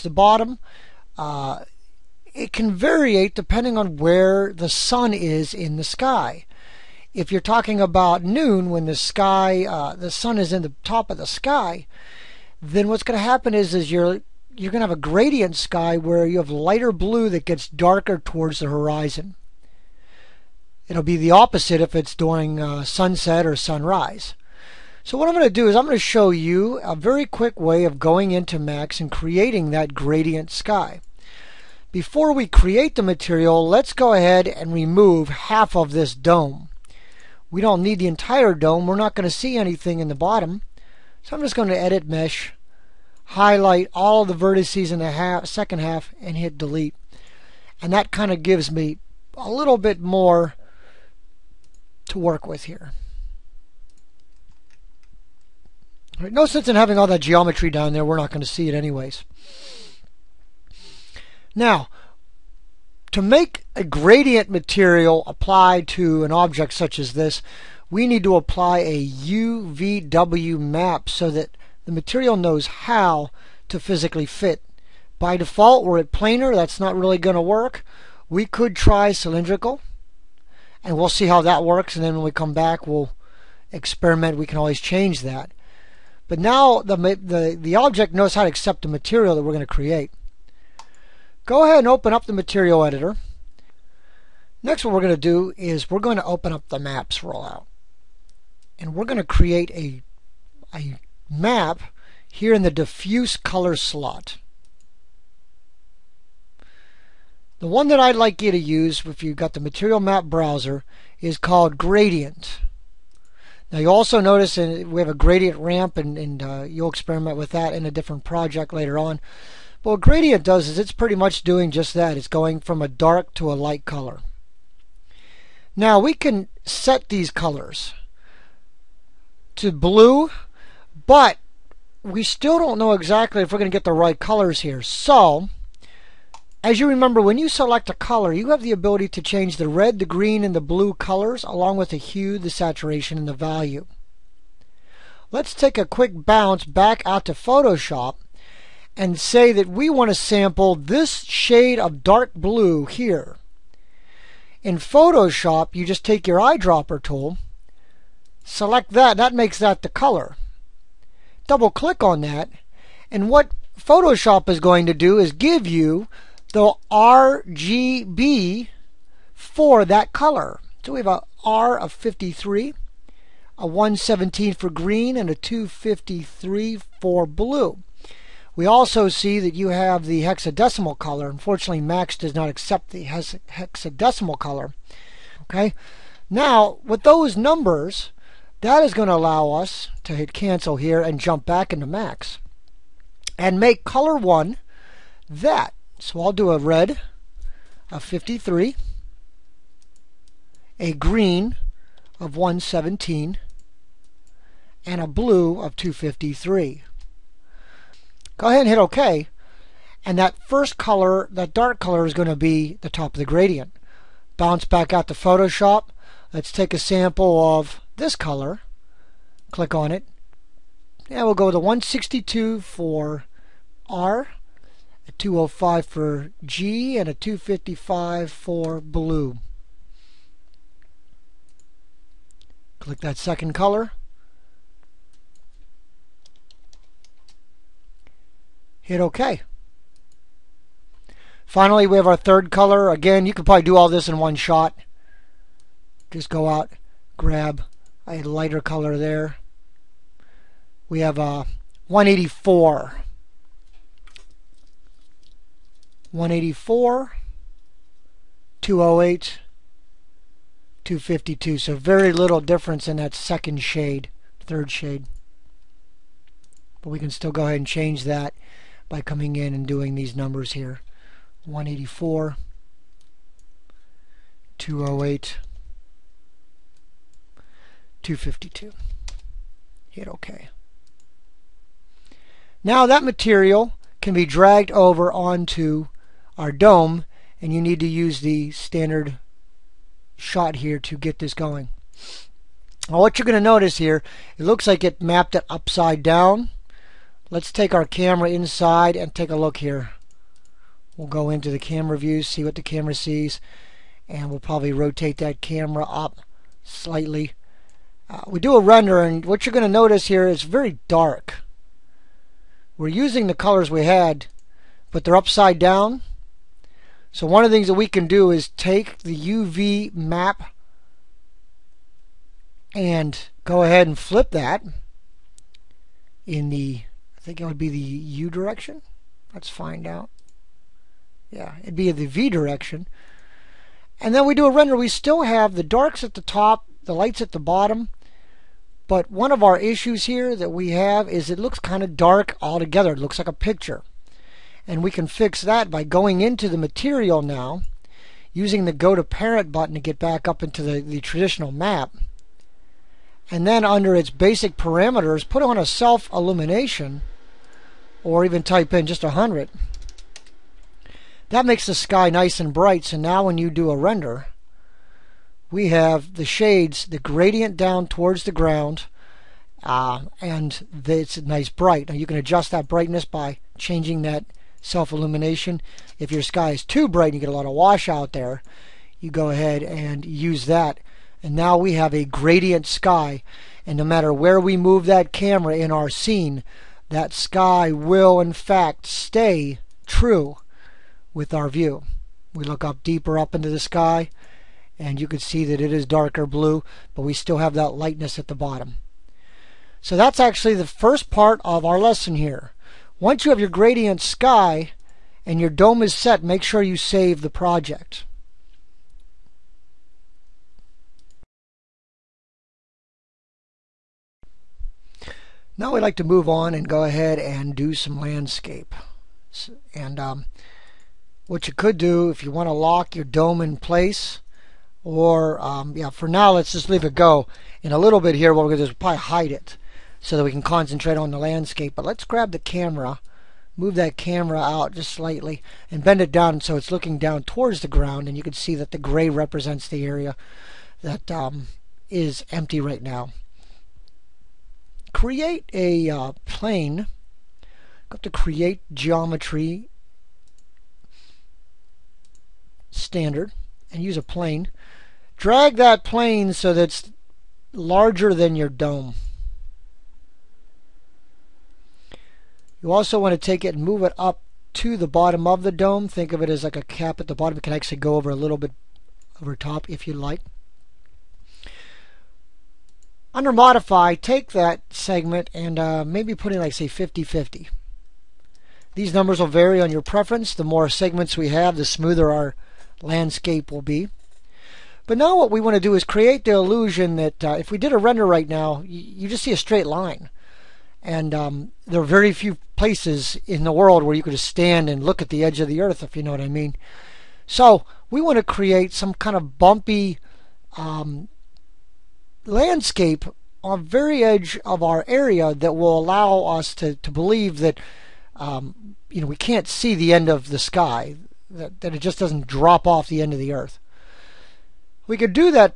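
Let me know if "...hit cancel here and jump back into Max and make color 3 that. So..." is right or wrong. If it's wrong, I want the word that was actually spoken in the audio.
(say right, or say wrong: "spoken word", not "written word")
wrong: "1", not "3".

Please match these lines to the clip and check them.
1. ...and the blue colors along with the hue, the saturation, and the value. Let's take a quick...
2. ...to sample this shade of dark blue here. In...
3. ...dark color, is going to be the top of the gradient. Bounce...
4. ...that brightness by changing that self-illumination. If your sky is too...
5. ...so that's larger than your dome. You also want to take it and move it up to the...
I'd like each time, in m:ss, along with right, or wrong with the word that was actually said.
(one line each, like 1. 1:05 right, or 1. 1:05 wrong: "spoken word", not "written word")
1. 2:20 right
2. 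2:30 right
3. 3:31 right
4. 6:12 right
5. 7:36 right.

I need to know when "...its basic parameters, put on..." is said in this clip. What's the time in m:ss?
5:53.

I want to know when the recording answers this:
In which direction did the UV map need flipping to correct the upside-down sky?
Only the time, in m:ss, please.
5:32.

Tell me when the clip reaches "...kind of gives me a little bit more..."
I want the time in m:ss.
0:48.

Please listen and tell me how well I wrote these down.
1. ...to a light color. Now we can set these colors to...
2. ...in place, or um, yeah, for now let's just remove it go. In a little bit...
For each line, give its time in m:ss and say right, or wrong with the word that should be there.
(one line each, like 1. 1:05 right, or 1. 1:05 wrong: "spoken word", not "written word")
1. 2:03 right
2. 7:03 wrong: "leave", not "remove".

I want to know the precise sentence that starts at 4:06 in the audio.
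Just go out, grab a lighter color there.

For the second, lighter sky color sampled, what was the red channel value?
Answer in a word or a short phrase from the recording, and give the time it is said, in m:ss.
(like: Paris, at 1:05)
162, at 3:41.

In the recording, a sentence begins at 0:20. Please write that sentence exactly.
It'll be the opposite if it's during uh, sunset or sunrise.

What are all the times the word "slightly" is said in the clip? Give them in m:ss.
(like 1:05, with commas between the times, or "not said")
5:06, 7:14.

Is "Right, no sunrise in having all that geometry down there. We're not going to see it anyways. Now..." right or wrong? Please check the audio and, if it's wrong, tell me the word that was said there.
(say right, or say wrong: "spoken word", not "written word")
wrong: "sense", not "sunrise".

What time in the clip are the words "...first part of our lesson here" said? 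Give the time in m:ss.
6:40.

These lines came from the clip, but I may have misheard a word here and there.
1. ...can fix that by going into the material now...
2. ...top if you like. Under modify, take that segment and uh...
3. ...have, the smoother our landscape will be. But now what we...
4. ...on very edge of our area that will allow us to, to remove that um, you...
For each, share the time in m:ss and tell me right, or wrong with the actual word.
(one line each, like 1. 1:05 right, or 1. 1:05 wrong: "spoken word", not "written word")
1. 5:44 right
2. 7:49 right
3. 8:01 right
4. 8:23 wrong: "believe", not "remove".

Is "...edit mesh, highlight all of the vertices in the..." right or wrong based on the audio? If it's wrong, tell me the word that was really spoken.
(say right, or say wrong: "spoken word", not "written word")
right.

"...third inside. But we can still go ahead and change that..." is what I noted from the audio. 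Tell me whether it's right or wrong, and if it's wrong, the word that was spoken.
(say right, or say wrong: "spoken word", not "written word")
wrong: "shade", not "inside".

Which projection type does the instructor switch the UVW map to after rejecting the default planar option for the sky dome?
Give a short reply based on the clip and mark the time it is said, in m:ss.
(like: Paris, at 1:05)
Cylindrical, at 1:19.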